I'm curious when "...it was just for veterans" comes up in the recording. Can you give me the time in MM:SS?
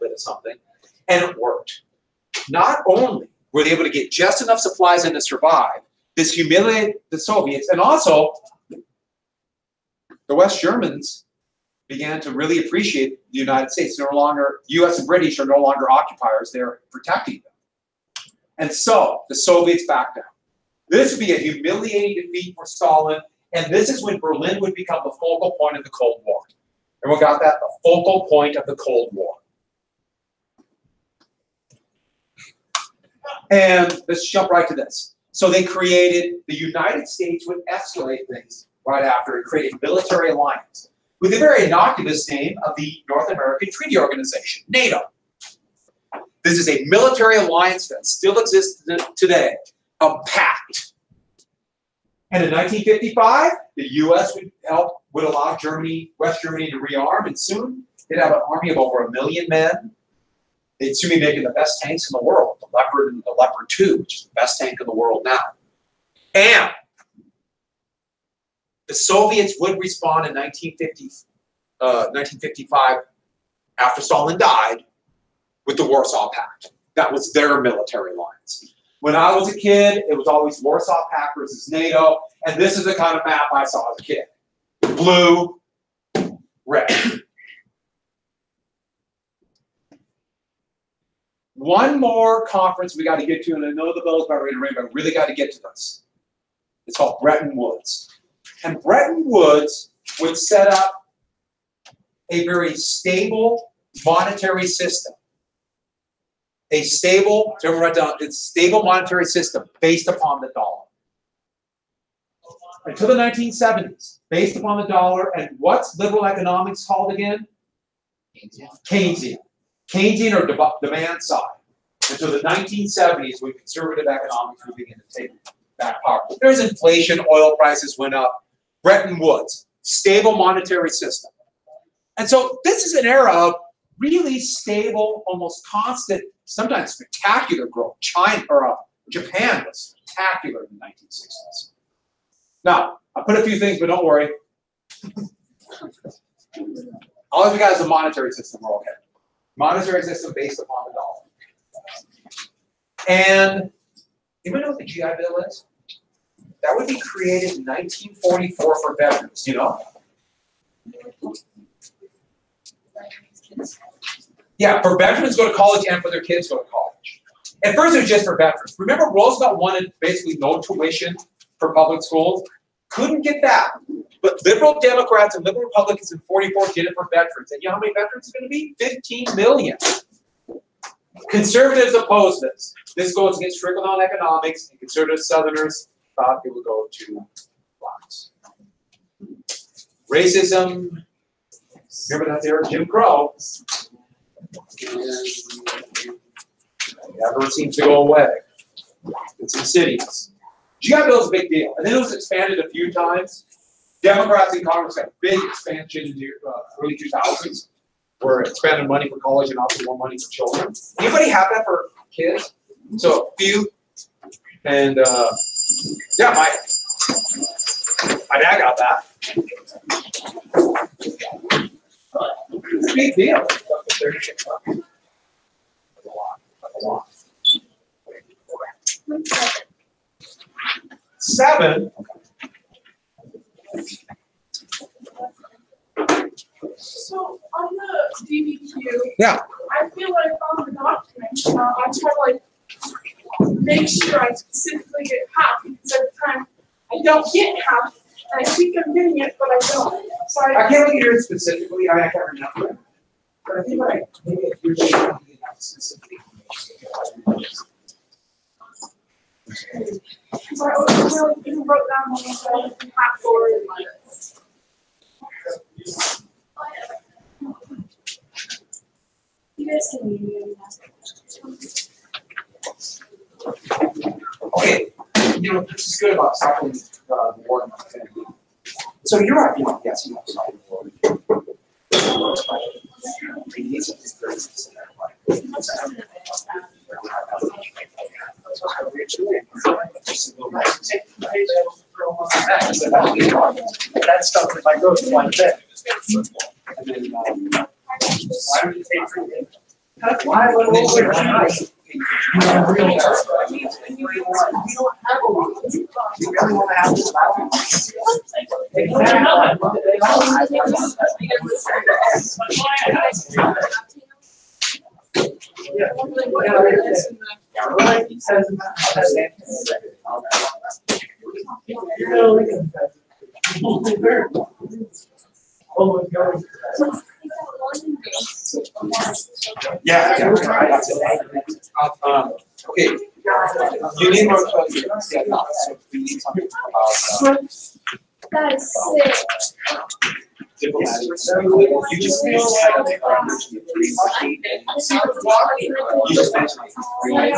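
02:47.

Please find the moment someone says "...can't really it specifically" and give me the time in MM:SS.
04:10.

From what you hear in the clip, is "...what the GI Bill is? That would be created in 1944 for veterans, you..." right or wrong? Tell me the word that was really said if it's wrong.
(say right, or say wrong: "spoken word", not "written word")
right.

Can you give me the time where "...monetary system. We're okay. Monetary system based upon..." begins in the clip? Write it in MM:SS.
02:27.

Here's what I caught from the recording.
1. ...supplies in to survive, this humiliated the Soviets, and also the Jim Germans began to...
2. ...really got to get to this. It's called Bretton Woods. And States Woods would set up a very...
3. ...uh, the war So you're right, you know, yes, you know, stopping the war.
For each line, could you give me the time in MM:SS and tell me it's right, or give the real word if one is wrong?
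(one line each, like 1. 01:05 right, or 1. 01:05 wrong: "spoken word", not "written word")
1. 00:04 wrong: "West", not "Jim"
2. 01:34 wrong: "Bretton", not "States"
3. 04:37 right.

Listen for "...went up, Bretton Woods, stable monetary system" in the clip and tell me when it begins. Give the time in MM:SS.
02:07.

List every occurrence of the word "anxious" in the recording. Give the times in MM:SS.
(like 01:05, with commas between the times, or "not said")
not said.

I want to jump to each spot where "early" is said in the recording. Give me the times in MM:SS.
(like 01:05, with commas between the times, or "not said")
03:26.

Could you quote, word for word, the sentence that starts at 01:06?
And the Soviets would respond in 1950, uh, 1955, after Stalin died, with the Warsaw Pact.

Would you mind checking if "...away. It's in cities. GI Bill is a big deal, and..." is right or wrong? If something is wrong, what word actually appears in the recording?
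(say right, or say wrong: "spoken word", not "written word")
right.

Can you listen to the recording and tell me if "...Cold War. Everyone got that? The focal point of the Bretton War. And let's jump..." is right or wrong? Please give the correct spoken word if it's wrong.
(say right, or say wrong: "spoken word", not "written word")
wrong: "Cold", not "Bretton".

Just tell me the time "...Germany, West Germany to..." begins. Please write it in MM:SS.
00:55.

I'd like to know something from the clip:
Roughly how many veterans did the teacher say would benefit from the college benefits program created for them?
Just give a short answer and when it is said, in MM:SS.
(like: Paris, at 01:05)
15 million, at 02:58.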